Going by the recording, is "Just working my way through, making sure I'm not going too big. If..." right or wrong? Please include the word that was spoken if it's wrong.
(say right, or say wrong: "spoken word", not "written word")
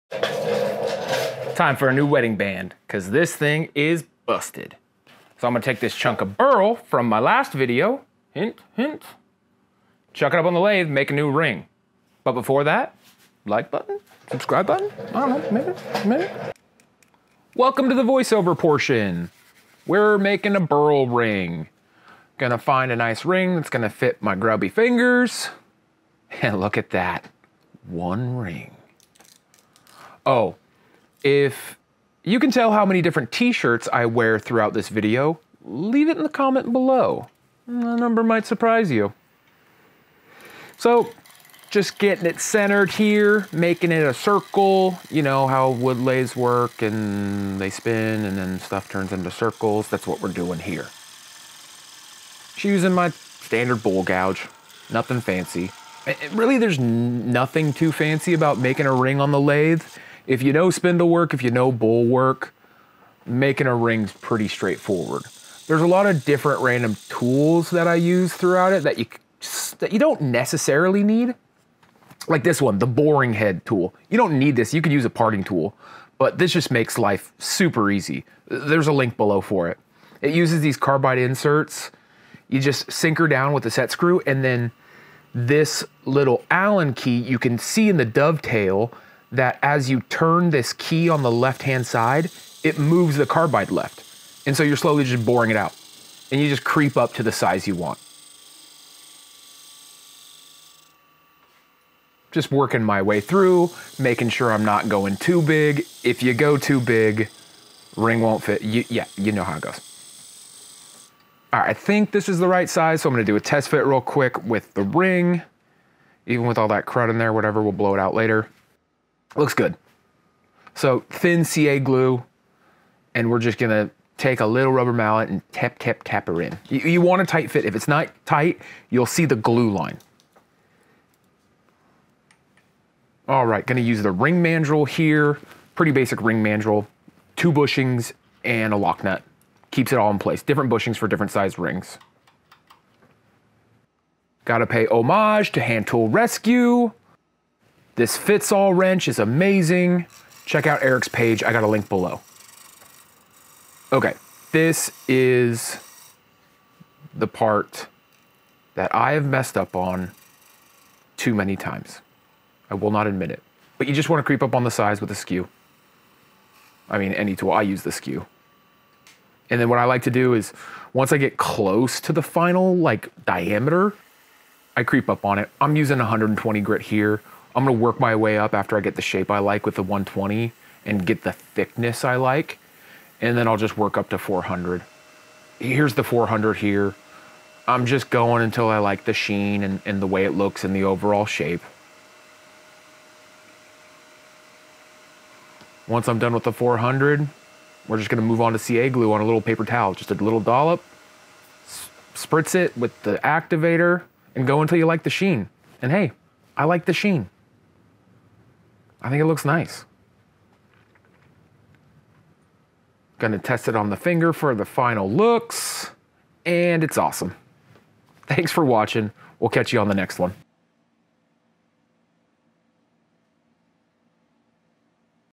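right.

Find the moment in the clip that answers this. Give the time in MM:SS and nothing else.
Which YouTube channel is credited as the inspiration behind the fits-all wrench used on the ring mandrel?
02:25.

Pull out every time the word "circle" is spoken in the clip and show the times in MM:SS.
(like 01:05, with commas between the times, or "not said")
00:44, 00:49.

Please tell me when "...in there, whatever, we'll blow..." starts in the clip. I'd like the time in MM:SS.
01:57.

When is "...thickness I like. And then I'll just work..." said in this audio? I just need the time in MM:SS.
03:01.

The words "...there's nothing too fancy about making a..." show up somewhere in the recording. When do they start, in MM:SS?
00:56.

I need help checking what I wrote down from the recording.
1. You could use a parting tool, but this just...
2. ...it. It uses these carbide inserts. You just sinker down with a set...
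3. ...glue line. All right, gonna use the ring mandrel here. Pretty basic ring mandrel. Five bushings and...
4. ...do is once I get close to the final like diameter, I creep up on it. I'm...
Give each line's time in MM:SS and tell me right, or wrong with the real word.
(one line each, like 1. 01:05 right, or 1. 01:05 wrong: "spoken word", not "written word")
1. 01:14 right
2. 01:19 right
3. 02:09 wrong: "Two", not "Five"
4. 02:50 right.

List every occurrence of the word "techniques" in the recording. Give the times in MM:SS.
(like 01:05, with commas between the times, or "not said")
not said.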